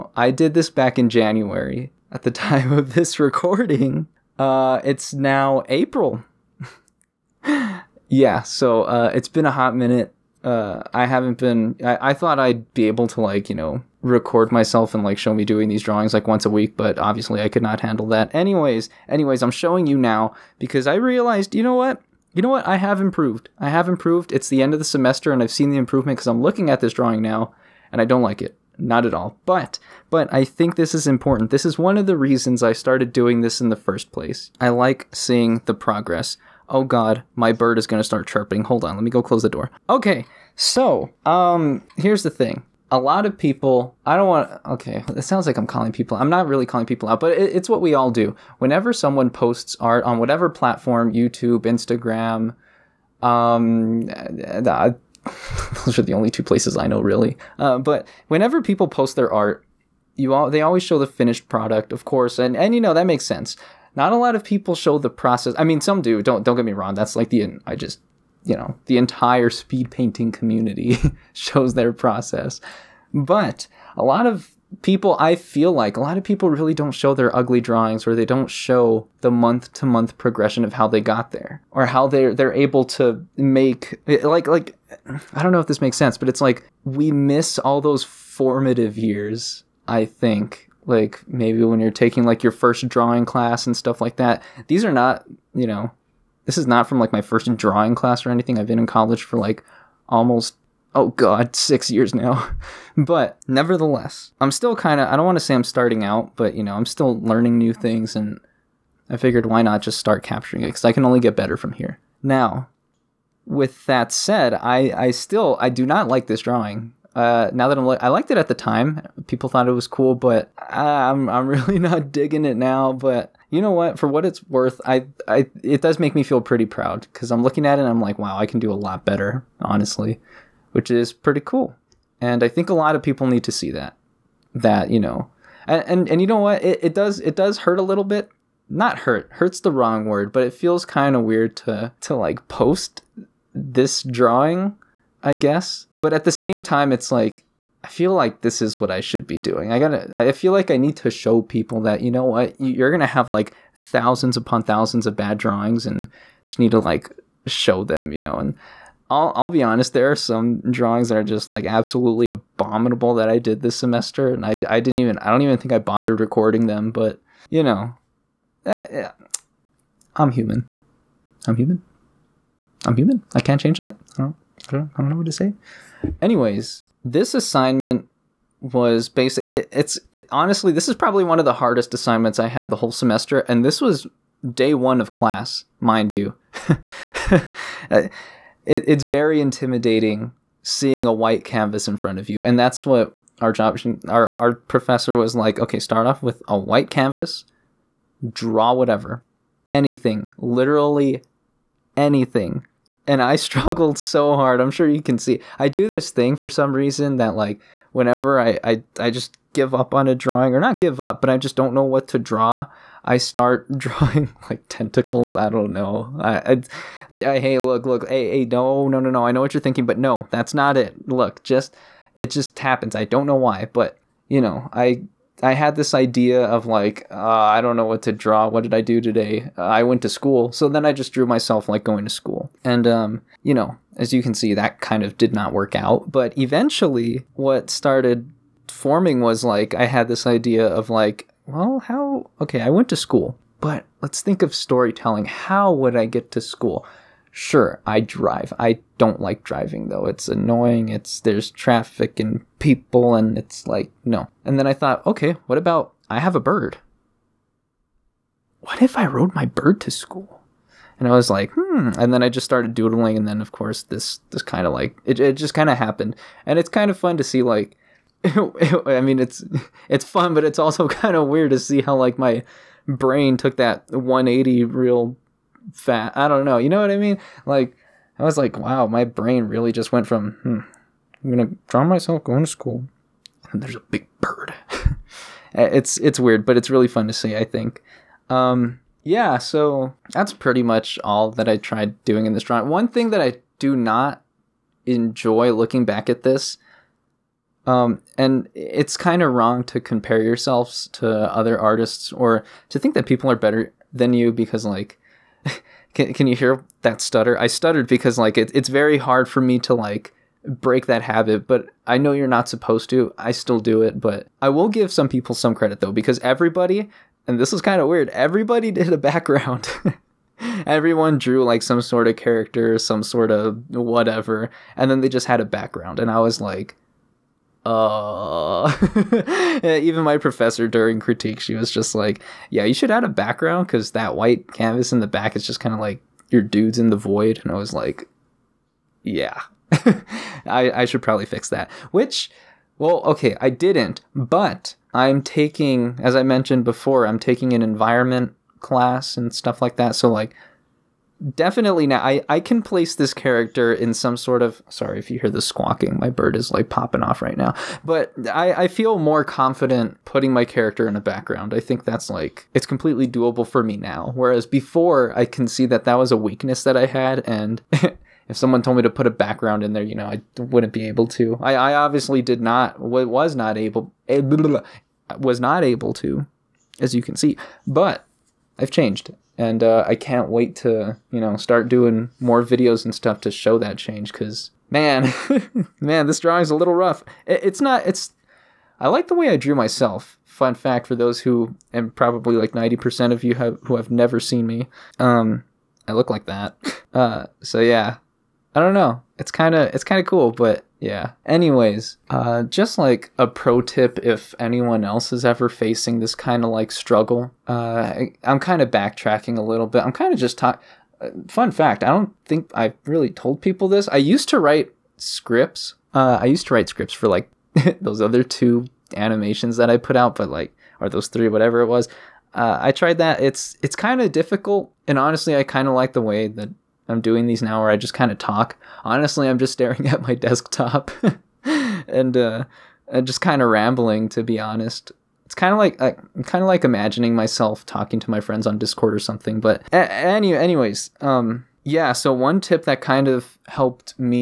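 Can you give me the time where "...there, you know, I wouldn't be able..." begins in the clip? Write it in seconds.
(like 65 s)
369 s.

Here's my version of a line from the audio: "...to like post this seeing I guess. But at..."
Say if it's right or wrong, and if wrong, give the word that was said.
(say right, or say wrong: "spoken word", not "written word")
wrong: "drawing", not "seeing".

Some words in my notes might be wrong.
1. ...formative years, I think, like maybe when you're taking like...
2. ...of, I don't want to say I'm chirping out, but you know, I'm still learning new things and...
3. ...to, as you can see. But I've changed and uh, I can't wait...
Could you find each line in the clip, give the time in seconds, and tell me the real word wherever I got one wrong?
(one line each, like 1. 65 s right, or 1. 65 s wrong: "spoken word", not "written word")
1. 88 s right
2. 105 s wrong: "starting", not "chirping"
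3. 375 s right.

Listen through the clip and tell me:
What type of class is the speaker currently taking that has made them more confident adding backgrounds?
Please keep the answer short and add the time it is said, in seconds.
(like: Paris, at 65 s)
Environment class, at 347 s.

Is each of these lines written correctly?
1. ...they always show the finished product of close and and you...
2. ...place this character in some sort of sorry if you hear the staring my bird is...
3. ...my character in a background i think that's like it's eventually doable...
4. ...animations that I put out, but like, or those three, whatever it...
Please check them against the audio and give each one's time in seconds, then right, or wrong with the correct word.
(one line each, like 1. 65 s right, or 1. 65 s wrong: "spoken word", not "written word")
1. 60 s wrong: "course", not "close"
2. 352 s wrong: "squawking", not "staring"
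3. 360 s wrong: "completely", not "eventually"
4. 418 s right.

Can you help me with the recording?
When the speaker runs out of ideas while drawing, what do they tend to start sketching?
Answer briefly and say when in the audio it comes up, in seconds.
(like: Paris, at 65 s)
Tentacles, at 214 s.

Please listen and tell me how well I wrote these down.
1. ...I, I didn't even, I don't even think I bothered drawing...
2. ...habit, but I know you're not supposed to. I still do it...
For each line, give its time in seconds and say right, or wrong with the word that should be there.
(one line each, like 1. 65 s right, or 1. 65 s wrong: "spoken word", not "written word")
1. 164 s wrong: "recording", not "drawing"
2. 311 s right.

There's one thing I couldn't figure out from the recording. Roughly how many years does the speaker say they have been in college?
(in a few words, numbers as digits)
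6.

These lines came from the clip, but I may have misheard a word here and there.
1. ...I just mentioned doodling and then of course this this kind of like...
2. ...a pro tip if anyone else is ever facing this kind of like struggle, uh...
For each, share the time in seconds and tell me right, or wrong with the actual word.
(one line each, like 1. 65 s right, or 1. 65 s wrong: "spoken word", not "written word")
1. 262 s wrong: "started", not "mentioned"
2. 403 s right.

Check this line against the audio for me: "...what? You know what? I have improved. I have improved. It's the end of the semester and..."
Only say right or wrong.
right.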